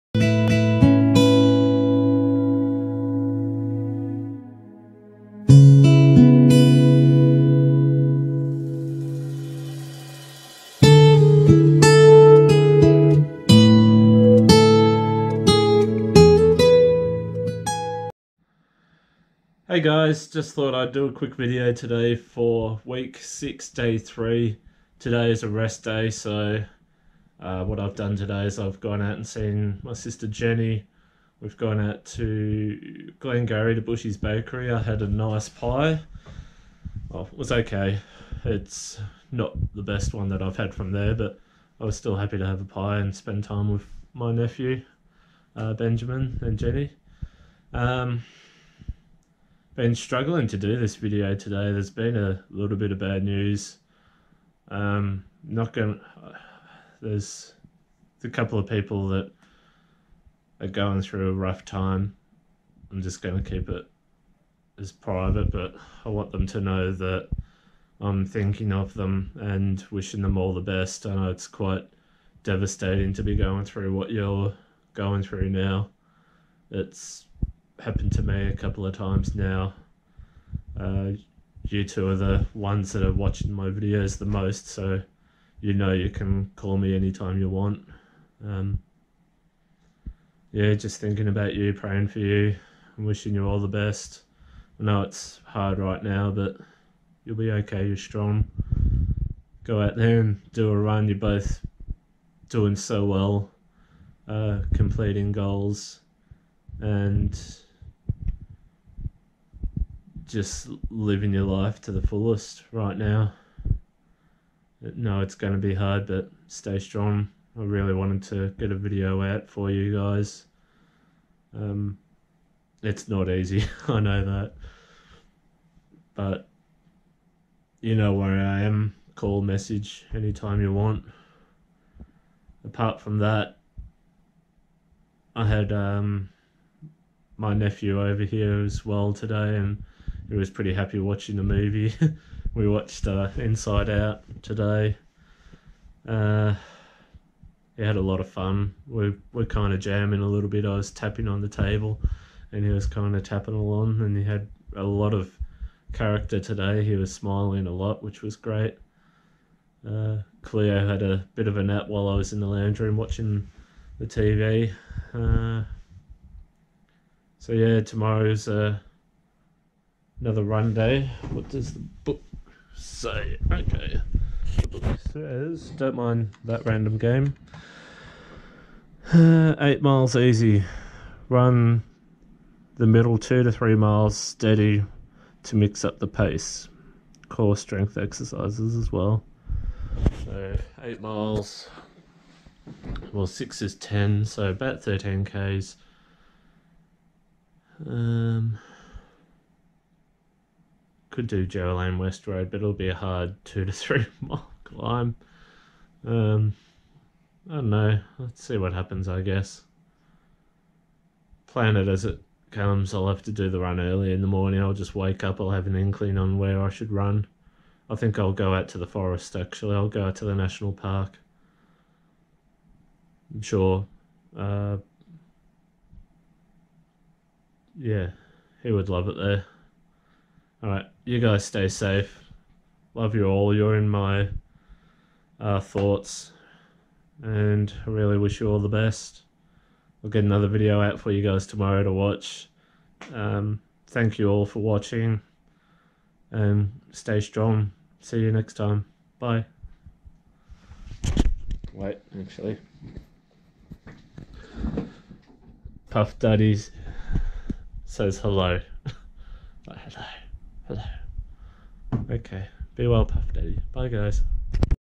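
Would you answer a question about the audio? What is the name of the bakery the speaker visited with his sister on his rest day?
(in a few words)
Bushy's Bakery.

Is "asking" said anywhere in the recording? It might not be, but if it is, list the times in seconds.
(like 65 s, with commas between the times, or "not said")
not said.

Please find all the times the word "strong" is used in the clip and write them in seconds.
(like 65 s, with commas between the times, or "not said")
97 s, 116 s, 247 s.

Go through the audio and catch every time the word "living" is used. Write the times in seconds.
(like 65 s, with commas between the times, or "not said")
110 s.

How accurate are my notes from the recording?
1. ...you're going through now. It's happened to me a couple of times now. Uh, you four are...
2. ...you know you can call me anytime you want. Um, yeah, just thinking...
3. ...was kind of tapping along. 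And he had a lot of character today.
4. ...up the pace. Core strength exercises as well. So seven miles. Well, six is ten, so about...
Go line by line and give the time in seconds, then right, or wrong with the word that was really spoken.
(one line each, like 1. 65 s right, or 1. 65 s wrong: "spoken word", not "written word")
1. 74 s wrong: "two", not "four"
2. 85 s right
3. 152 s right
4. 185 s wrong: "eight", not "seven".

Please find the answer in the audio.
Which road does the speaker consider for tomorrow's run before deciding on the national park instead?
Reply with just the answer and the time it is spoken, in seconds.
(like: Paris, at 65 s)
Joe West Road, at 201 s.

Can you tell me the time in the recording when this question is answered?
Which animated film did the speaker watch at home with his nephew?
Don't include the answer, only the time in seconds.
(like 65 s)
143 s.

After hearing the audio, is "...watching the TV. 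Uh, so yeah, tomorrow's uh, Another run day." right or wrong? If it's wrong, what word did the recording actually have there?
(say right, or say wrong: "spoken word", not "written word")
right.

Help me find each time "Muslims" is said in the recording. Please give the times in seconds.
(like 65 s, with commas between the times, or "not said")
not said.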